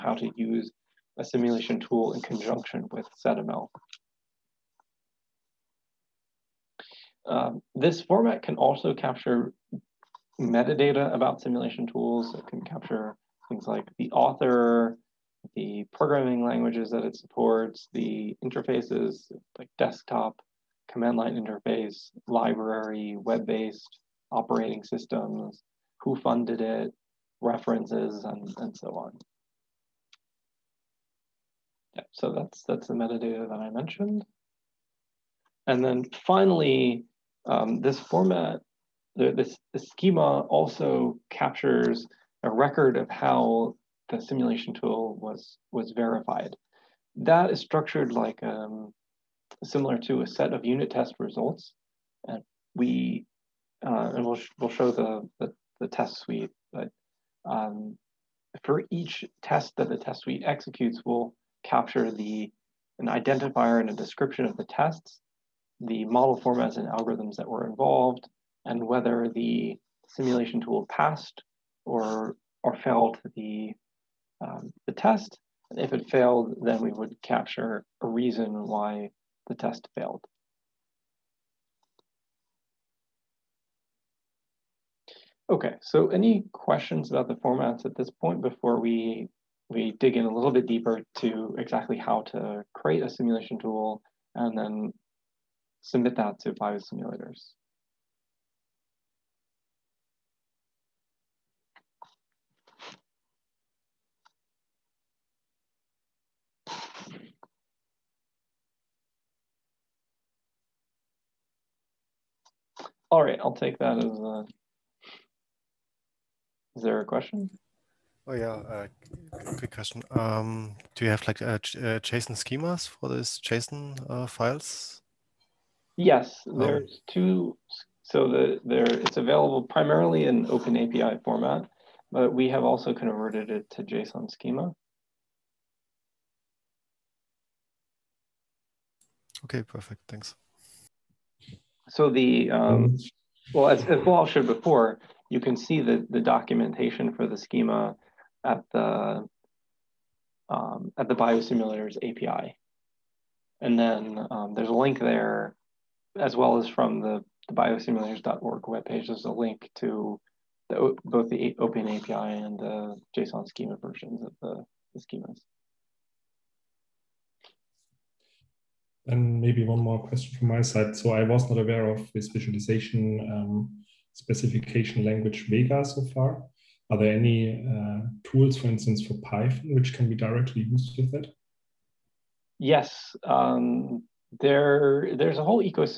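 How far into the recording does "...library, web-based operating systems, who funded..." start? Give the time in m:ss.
0:22.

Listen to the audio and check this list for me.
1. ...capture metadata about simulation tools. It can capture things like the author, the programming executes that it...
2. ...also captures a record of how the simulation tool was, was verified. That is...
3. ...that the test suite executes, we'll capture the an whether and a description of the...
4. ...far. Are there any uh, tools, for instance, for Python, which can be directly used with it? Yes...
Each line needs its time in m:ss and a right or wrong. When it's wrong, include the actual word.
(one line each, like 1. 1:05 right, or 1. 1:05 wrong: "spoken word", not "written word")
1. 0:08 wrong: "languages", not "executes"
2. 0:40 right
3. 0:59 wrong: "identifier", not "whether"
4. 2:56 right.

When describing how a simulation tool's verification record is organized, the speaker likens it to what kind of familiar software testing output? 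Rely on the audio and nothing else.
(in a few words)
unit test results.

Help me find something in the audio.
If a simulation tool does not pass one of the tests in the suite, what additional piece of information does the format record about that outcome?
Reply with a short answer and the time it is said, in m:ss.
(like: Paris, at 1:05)
a reason, at 1:18.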